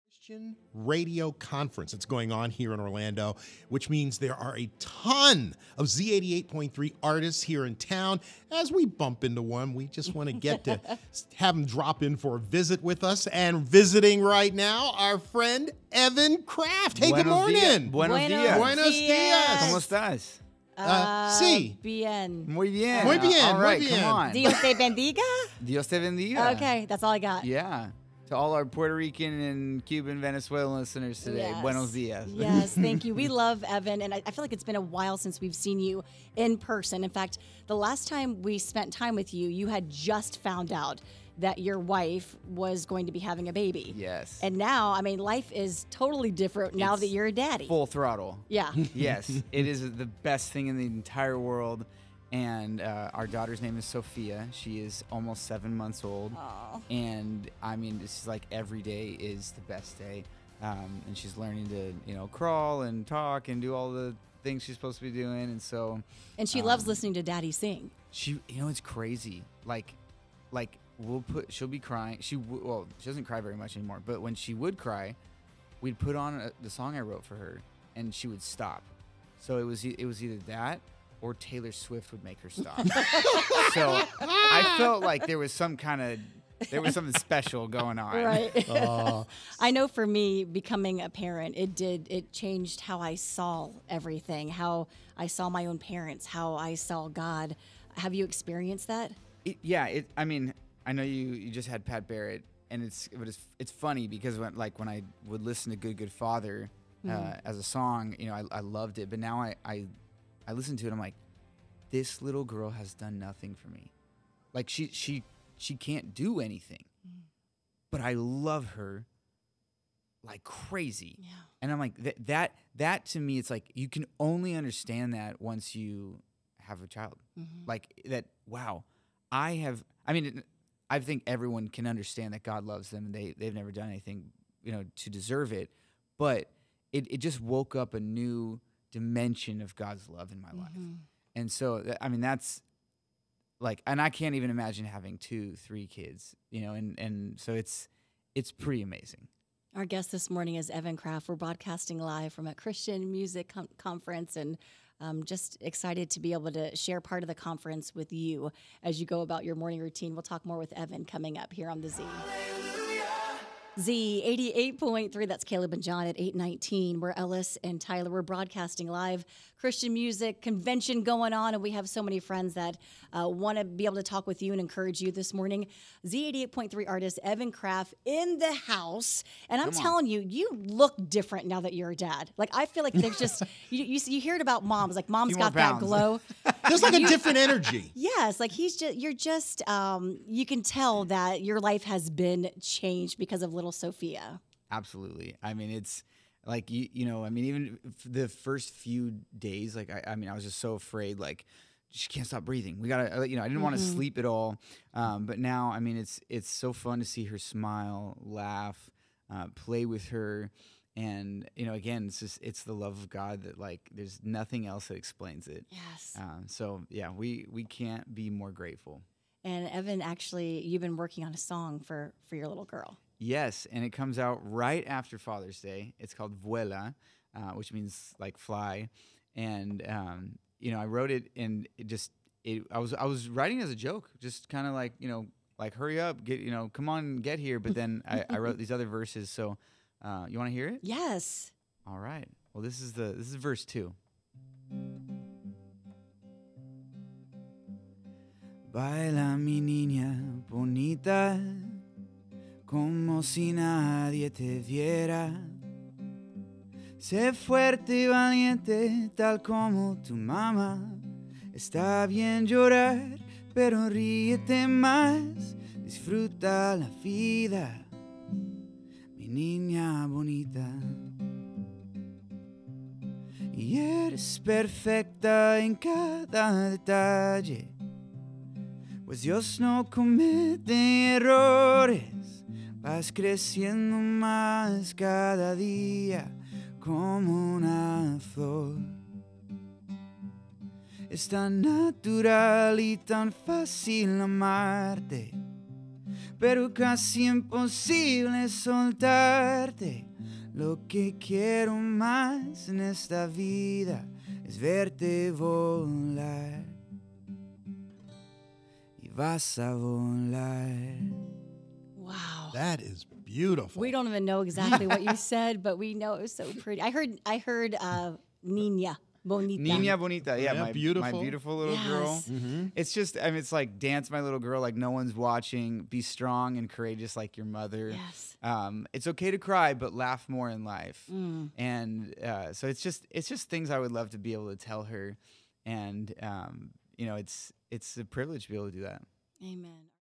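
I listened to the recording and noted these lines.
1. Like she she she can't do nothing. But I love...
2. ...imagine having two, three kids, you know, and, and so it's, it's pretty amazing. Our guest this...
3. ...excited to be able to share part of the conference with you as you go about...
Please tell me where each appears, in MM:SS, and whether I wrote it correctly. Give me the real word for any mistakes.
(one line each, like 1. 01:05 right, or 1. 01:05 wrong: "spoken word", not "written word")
1. 01:54 wrong: "anything", not "nothing"
2. 02:24 right
3. 02:35 right.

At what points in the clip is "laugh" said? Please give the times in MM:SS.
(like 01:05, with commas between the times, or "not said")
03:28, 05:29.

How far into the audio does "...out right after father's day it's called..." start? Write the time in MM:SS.
03:44.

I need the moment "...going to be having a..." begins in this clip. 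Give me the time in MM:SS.
00:42.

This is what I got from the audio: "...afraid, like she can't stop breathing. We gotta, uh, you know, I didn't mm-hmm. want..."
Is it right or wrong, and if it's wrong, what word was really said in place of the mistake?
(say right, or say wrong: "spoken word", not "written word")
right.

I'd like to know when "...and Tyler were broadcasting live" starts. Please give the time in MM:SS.
02:47.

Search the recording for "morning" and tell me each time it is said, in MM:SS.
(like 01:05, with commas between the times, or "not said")
00:17, 02:30, 02:39, 02:55.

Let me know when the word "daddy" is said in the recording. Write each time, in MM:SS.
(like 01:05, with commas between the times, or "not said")
00:47, 01:07.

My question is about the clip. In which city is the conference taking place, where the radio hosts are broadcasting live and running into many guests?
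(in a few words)
Orlando.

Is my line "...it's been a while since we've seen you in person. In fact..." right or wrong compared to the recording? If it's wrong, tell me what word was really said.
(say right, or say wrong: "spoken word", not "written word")
right.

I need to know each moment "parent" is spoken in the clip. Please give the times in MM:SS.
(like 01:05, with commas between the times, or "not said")
01:31, 01:35.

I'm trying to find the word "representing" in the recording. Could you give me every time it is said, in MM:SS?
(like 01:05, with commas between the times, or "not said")
not said.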